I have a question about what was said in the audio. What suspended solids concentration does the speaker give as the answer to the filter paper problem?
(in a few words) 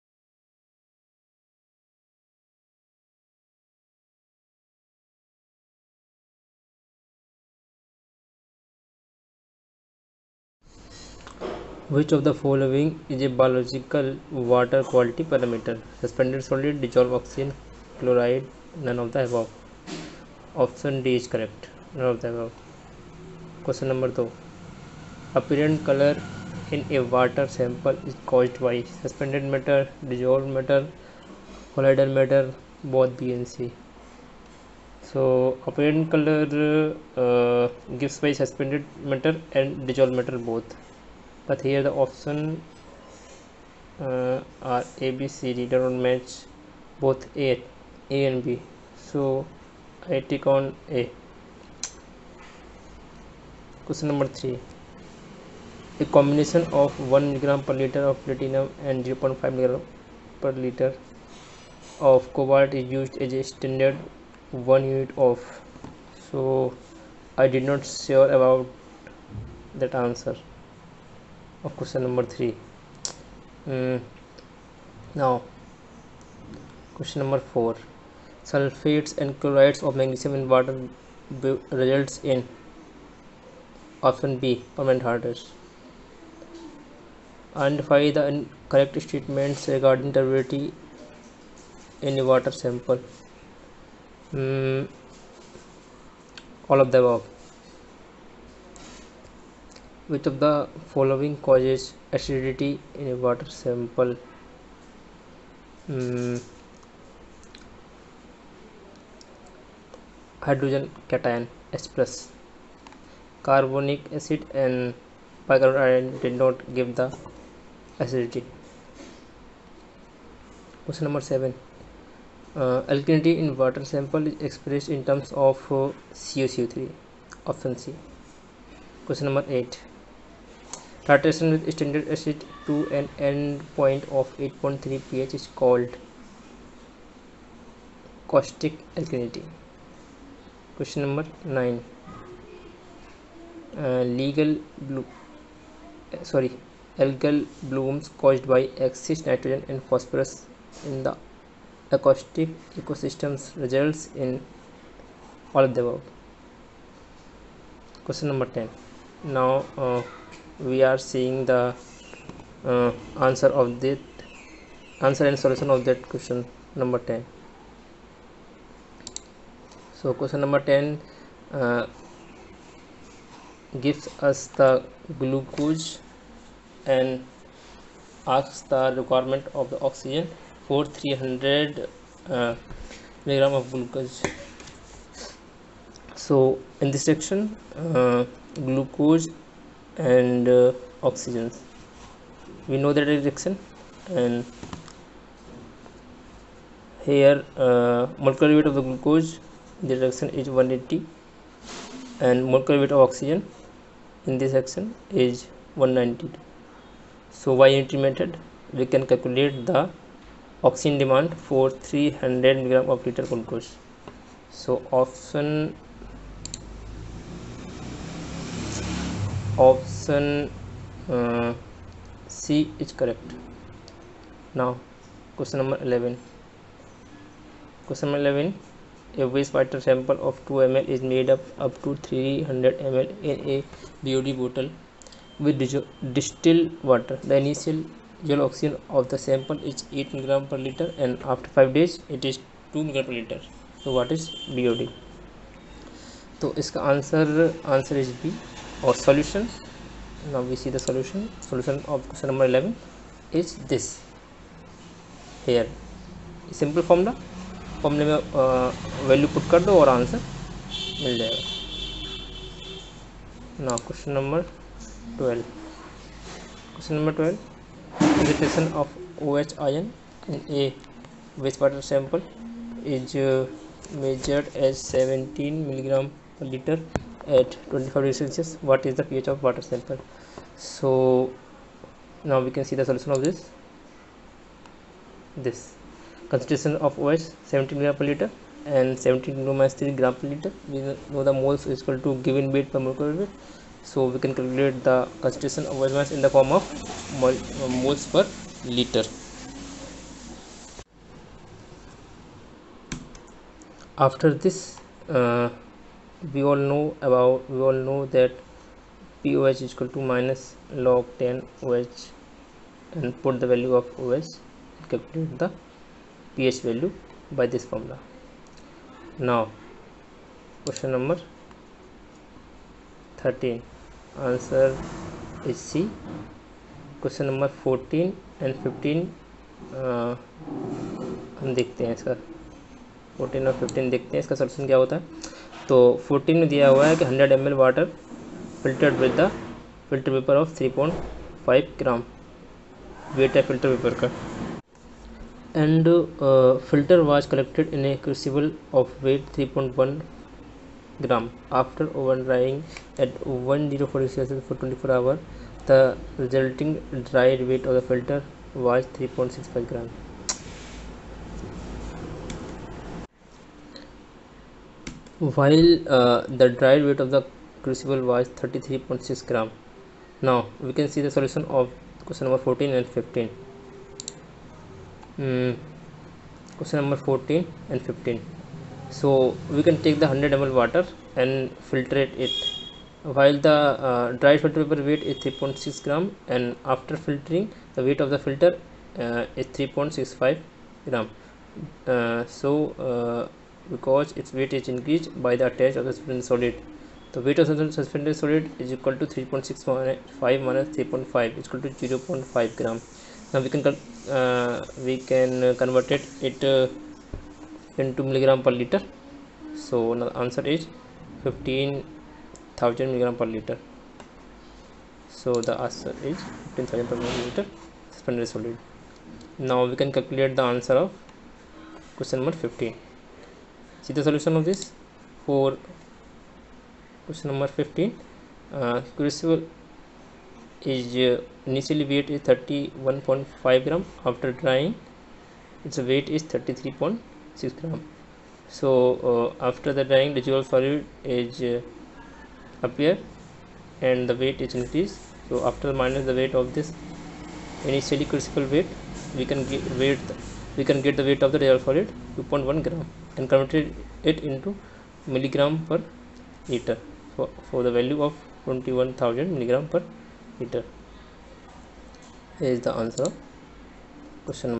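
15,000 mg/L.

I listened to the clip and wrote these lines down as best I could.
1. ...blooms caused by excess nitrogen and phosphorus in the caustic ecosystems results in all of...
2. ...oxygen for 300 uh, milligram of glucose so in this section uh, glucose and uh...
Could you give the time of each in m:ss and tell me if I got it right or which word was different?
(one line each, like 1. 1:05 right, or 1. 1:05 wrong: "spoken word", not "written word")
1. 2:27 wrong: "aquatic", not "caustic"
2. 2:59 right.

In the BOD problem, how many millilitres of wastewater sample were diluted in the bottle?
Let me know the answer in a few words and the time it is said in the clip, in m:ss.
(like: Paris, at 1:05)
2 ml, at 3:50.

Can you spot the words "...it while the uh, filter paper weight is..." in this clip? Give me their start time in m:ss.
6:22.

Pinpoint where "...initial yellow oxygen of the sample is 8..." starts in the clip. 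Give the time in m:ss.
3:57.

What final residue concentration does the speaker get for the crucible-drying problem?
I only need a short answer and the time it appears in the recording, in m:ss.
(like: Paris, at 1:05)
21,000 mg/L, at 7:38.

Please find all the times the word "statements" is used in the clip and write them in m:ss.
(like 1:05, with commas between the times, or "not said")
1:29.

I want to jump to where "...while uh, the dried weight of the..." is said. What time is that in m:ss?
6:05.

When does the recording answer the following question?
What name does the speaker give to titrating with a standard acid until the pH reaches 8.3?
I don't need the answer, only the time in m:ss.
2:18.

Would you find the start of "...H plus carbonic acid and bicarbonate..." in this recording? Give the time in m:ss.
1:51.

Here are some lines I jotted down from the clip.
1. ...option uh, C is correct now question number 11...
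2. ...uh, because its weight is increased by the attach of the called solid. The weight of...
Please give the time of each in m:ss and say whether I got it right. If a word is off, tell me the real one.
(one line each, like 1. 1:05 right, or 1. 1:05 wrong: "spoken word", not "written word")
1. 3:39 right
2. 6:32 wrong: "suspended", not "called".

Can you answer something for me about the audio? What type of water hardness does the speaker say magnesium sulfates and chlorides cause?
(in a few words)
permanent hardness.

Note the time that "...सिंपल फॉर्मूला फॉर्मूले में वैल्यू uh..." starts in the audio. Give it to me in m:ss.
4:16.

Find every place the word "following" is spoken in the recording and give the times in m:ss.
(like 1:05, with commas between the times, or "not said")
0:12, 1:40.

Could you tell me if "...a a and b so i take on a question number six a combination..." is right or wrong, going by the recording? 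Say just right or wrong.
wrong.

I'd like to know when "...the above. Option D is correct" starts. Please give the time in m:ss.
0:19.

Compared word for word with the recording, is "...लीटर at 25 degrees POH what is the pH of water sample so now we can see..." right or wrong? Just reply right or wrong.
wrong.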